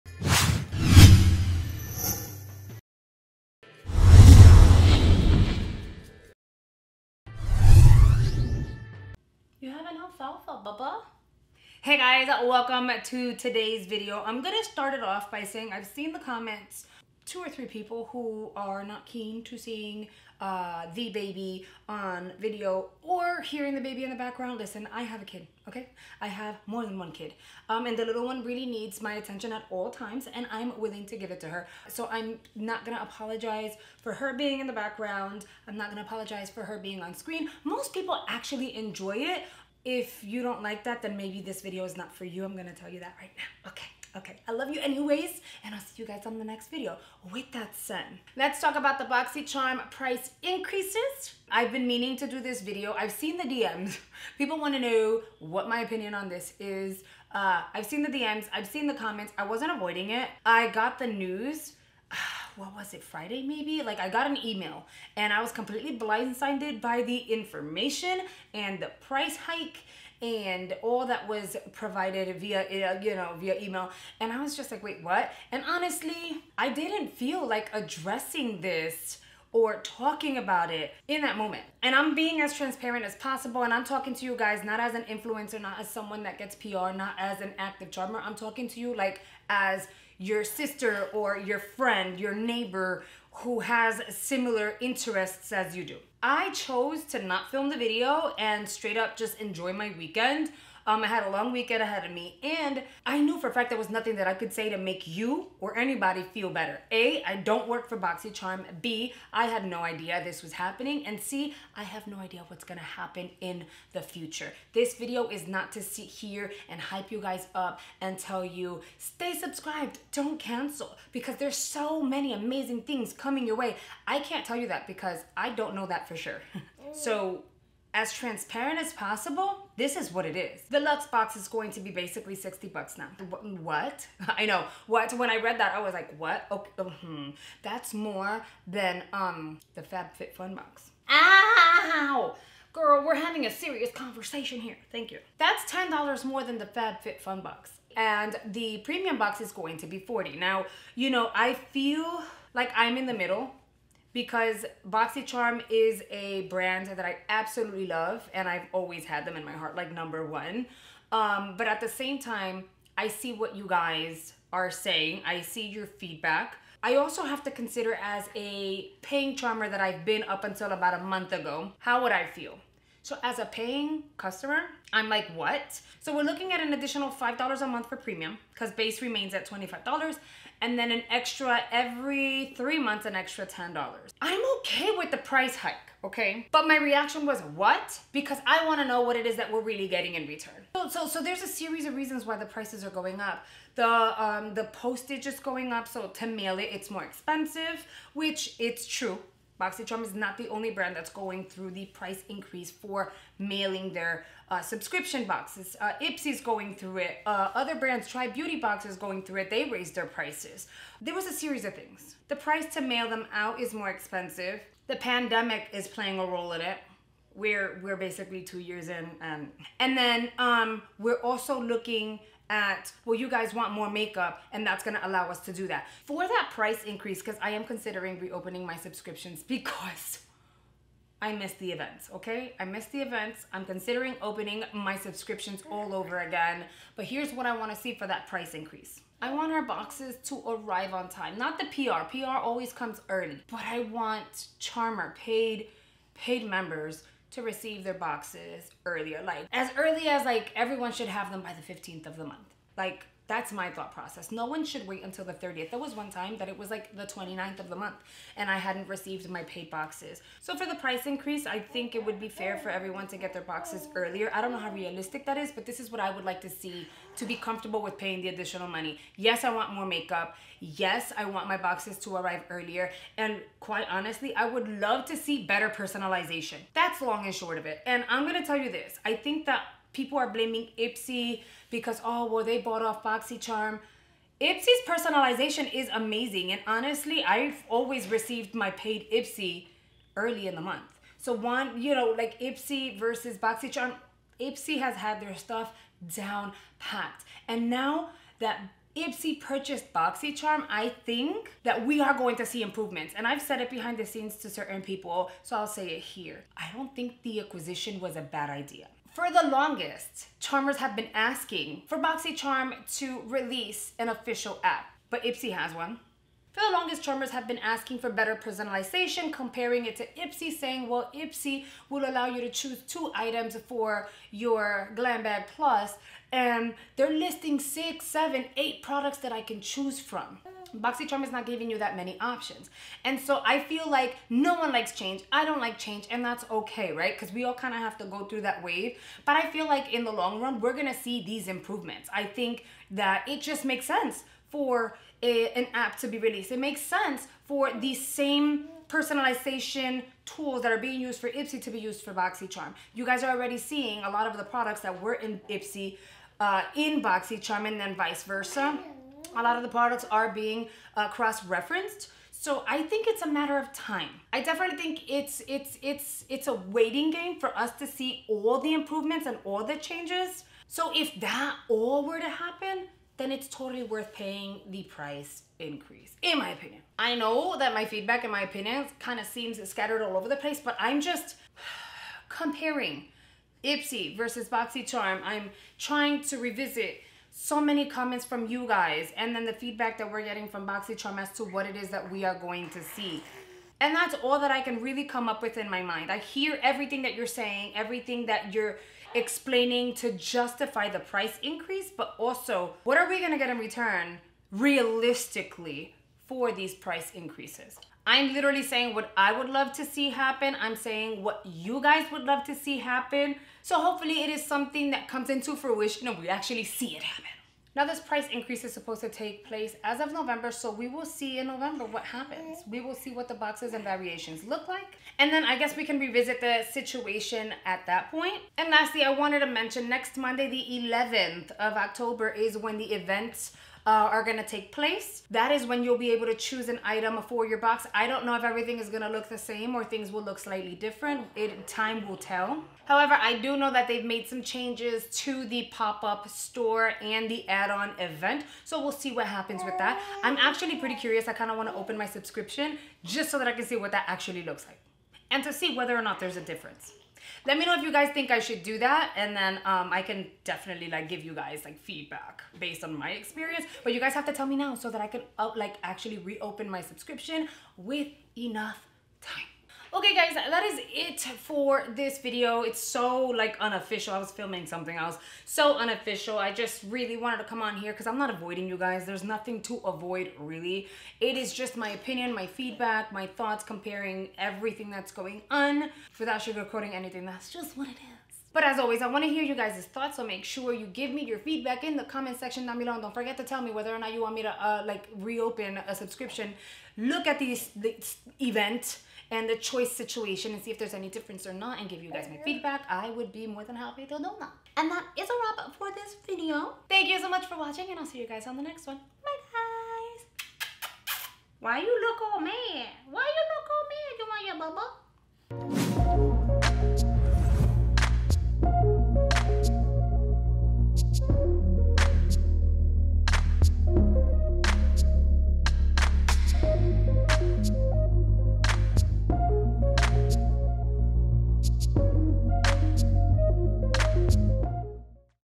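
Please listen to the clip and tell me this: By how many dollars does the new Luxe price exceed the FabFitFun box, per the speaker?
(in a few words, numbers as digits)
$10.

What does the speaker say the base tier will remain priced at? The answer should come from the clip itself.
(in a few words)
$25.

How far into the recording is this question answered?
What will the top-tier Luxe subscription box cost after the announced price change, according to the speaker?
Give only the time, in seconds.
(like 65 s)
132 s.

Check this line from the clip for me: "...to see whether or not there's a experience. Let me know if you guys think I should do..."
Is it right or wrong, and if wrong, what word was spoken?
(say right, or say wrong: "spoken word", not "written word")
wrong: "difference", not "experience".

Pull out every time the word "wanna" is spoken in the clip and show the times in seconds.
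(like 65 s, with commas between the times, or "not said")
54 s, 188 s, 237 s.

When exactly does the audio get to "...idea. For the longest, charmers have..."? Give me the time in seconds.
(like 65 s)
308 s.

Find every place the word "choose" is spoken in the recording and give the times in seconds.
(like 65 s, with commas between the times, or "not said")
322 s, 329 s, 436 s.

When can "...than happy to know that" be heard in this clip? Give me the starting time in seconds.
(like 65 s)
503 s.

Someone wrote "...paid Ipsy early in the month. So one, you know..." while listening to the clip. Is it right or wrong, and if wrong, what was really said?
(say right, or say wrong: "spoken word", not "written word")
right.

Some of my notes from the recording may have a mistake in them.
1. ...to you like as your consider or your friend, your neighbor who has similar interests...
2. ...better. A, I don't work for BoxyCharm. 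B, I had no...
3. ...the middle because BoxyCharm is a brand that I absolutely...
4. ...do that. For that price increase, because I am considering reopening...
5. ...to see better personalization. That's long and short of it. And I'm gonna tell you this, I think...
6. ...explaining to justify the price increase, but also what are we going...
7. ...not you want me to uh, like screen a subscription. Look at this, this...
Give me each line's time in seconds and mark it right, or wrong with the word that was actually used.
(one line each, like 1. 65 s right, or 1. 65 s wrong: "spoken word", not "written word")
1. 88 s wrong: "sister", not "consider"
2. 106 s right
3. 153 s right
4. 225 s right
5. 275 s right
6. 399 s right
7. 493 s wrong: "reopen", not "screen".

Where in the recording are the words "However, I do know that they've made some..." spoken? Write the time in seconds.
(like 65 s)
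442 s.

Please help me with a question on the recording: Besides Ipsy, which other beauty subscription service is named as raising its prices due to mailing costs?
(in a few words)
Tribe Beauty Box.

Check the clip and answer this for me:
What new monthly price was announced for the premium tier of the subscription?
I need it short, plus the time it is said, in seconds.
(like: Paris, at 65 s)
$40, at 149 s.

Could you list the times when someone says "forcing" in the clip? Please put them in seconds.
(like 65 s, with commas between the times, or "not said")
not said.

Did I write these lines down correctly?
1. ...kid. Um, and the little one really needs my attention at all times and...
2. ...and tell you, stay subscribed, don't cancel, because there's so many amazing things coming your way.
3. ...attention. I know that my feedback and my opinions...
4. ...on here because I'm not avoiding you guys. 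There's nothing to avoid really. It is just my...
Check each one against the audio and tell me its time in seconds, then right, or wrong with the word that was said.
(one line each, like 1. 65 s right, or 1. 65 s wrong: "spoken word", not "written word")
1. 27 s right
2. 117 s right
3. 376 s wrong: "opinion", not "attention"
4. 477 s right.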